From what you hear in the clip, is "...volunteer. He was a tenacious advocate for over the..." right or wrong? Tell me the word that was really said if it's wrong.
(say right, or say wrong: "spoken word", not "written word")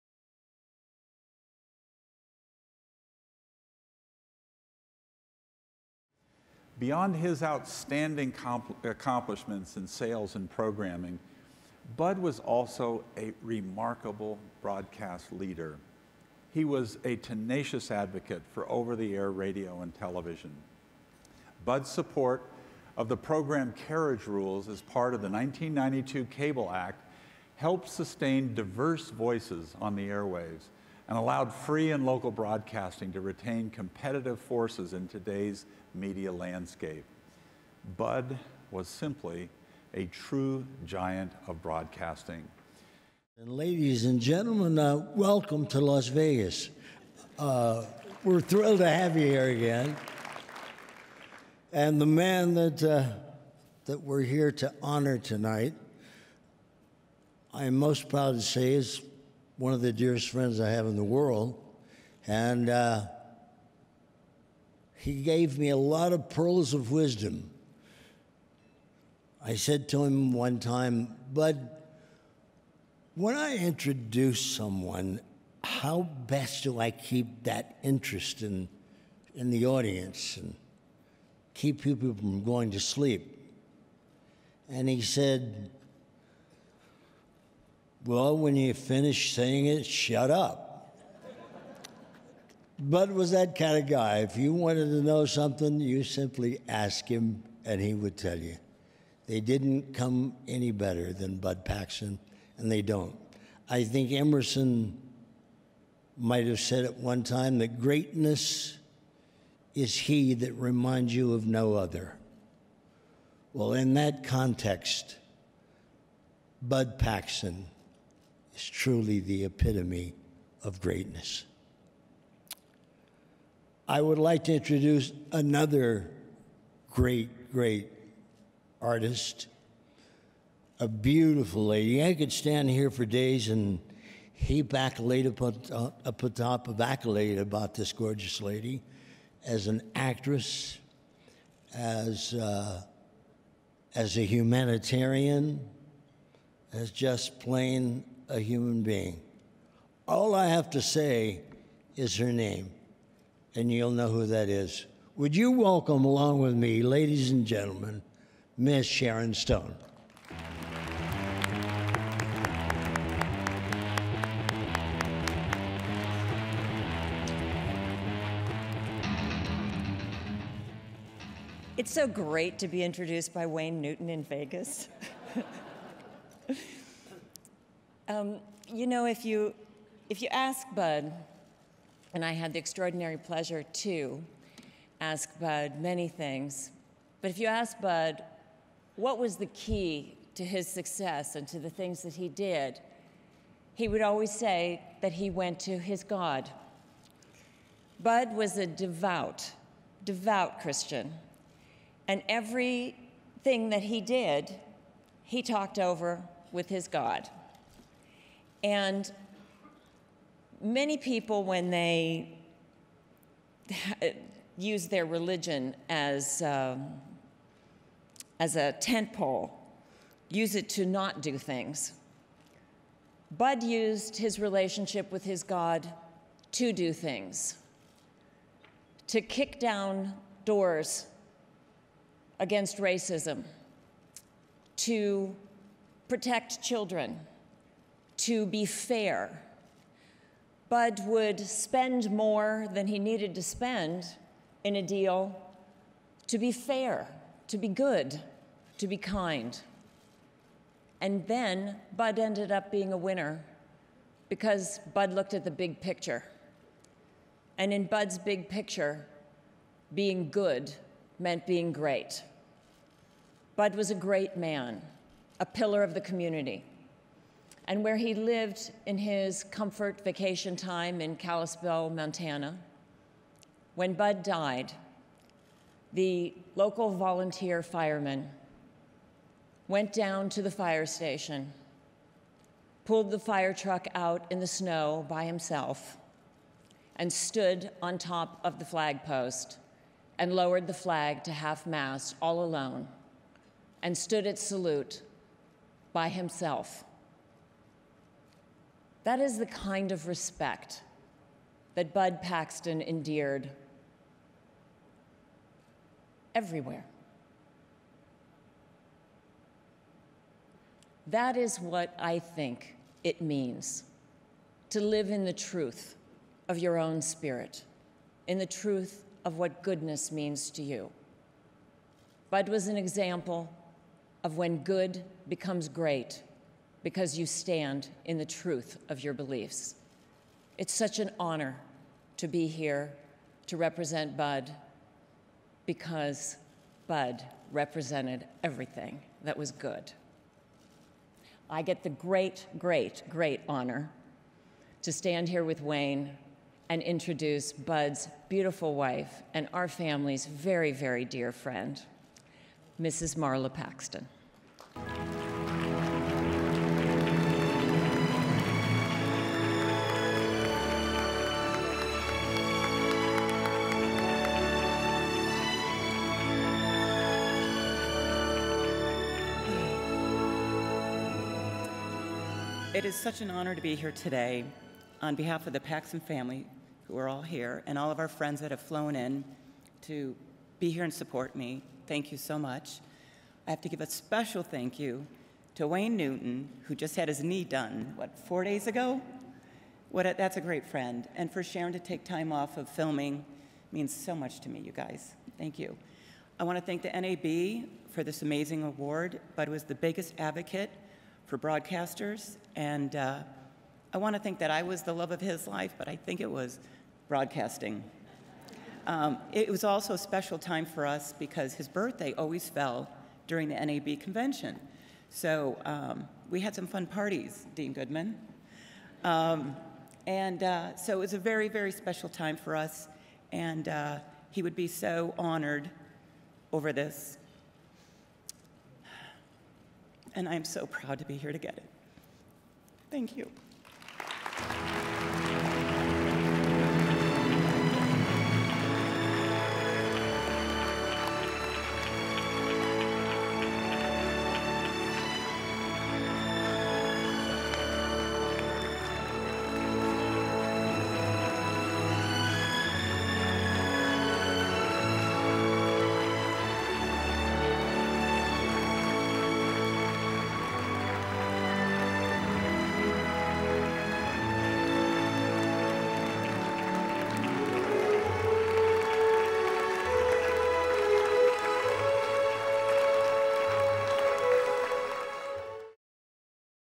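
wrong: "leader", not "volunteer".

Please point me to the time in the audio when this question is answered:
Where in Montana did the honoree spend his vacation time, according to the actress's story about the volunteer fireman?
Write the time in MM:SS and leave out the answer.
04:31.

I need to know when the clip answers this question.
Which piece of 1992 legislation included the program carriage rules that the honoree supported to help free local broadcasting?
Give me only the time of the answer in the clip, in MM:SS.
00:25.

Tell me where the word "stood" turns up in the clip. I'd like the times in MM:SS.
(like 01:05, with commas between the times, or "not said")
04:47, 04:53.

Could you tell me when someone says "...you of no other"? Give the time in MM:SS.
01:51.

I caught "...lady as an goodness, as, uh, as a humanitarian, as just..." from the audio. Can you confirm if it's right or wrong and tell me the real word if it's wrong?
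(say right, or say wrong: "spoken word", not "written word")
wrong: "actress", not "goodness".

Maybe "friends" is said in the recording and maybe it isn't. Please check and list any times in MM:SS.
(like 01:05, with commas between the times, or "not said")
01:00, 05:51, 06:18, 06:30.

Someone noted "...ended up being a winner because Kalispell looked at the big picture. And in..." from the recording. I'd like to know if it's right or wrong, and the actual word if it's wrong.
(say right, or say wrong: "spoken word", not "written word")
wrong: "Bud", not "Kalispell".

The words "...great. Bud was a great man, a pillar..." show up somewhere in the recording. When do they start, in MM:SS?
04:21.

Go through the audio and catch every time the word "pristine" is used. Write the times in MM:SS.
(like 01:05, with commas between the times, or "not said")
not said.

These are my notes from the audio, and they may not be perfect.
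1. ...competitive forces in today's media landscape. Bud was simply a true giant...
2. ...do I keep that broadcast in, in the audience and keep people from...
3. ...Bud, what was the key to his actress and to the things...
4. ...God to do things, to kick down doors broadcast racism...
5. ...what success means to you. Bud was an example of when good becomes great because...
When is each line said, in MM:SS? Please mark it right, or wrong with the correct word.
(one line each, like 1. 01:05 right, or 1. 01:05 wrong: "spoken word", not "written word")
1. 00:33 right
2. 01:16 wrong: "interest", not "broadcast"
3. 03:07 wrong: "success", not "actress"
4. 03:45 wrong: "against", not "broadcast"
5. 05:19 wrong: "goodness", not "success".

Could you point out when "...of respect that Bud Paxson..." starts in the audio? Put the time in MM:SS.
04:59.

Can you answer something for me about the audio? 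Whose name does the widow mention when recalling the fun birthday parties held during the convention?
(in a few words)
Dean Goodman.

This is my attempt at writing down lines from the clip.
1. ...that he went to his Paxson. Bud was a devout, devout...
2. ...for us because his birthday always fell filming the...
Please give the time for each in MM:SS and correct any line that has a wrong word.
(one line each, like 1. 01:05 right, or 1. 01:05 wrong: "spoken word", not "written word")
1. 03:15 wrong: "God", not "Paxson"
2. 06:50 wrong: "during", not "filming".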